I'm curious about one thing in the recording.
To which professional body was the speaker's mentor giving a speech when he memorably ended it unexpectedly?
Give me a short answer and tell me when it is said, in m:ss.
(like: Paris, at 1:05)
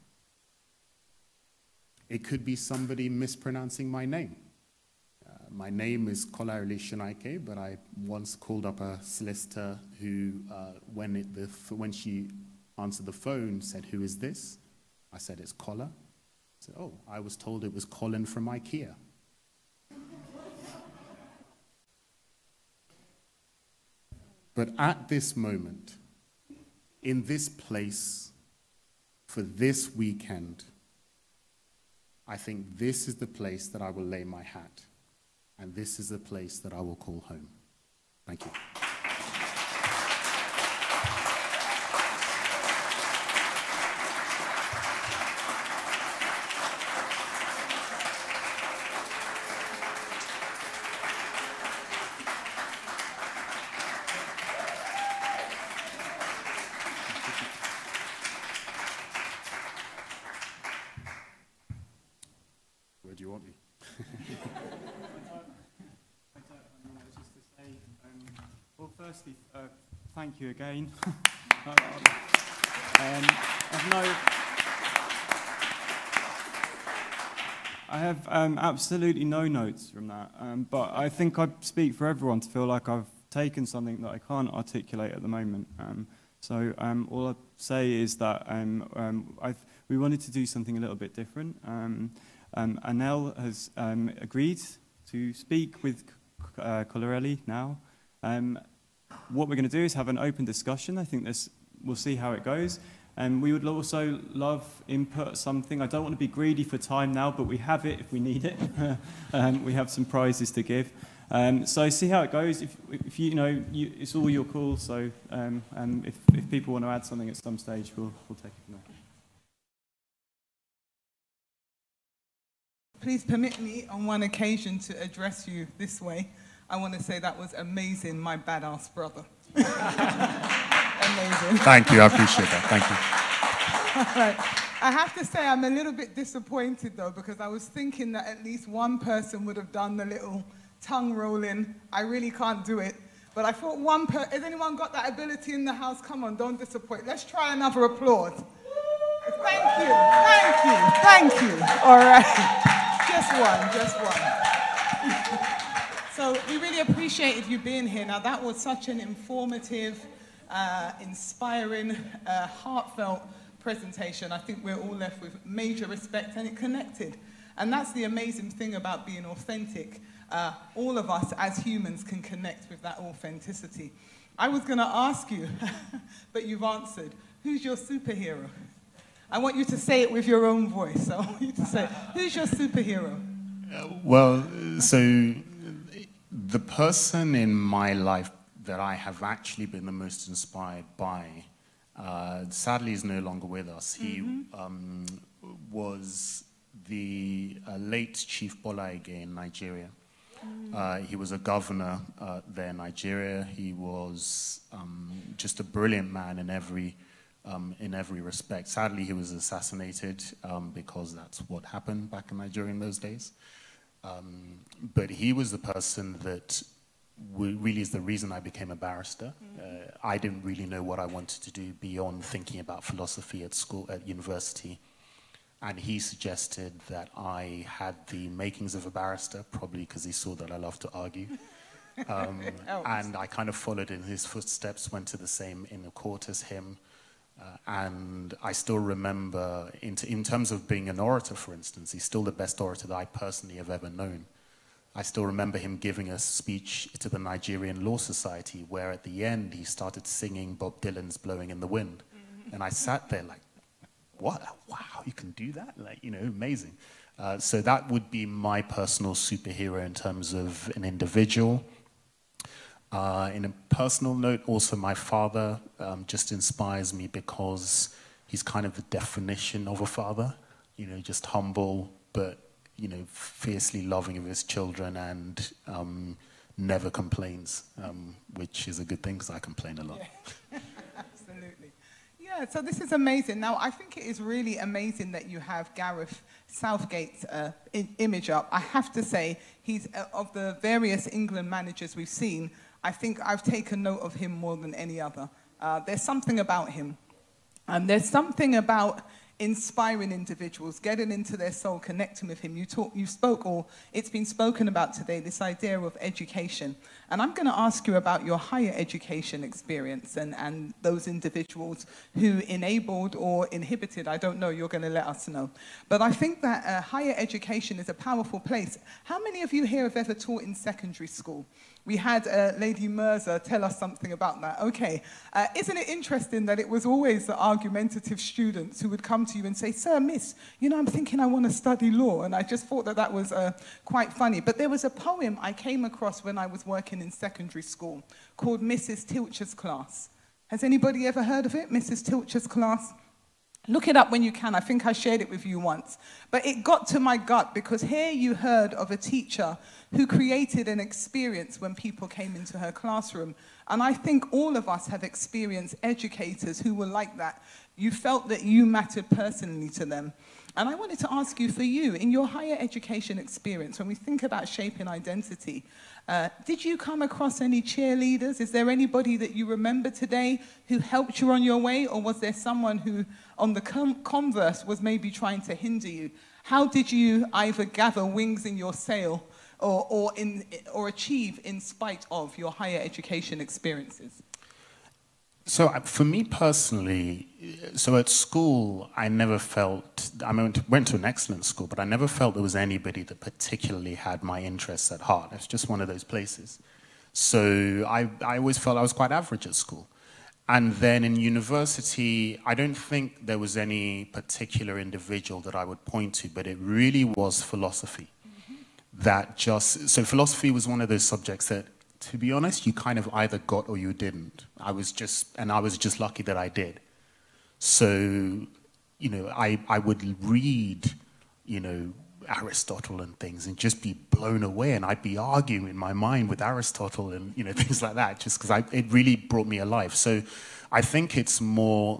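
Nigerian Law Society, at 4:07.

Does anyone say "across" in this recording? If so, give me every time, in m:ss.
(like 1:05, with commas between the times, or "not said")
5:35, 6:07.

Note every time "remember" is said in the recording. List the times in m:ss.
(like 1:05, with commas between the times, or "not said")
3:58, 4:05, 6:09.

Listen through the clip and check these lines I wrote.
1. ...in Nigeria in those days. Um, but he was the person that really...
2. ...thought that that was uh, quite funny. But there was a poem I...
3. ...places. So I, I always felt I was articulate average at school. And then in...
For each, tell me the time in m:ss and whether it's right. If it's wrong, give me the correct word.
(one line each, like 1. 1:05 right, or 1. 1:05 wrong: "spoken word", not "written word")
1. 3:32 right
2. 5:32 right
3. 6:36 wrong: "quite", not "articulate".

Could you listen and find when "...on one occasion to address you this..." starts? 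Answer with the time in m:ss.
2:03.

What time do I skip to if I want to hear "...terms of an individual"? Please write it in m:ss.
4:19.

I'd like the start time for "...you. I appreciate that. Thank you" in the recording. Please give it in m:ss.
2:11.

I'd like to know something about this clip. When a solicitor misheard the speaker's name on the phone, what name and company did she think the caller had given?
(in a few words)
Colin from IKEA.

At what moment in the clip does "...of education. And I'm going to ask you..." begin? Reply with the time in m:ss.
5:05.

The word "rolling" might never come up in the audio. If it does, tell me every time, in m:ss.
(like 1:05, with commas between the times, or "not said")
2:21.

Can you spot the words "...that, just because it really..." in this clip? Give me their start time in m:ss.
7:07.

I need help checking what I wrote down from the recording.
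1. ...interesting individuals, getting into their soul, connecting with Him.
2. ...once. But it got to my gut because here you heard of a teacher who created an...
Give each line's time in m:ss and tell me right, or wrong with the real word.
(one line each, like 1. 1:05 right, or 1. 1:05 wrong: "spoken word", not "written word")
1. 4:59 wrong: "inspiring", not "interesting"
2. 5:45 right.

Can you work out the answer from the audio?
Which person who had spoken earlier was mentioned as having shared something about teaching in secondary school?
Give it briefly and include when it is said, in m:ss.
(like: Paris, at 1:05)
Lady Mirza, at 5:22.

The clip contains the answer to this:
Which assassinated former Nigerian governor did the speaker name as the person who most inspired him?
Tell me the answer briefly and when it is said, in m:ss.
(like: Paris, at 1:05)
Chief Bola Ige, at 3:18.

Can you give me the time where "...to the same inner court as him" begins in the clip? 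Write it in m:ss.
3:55.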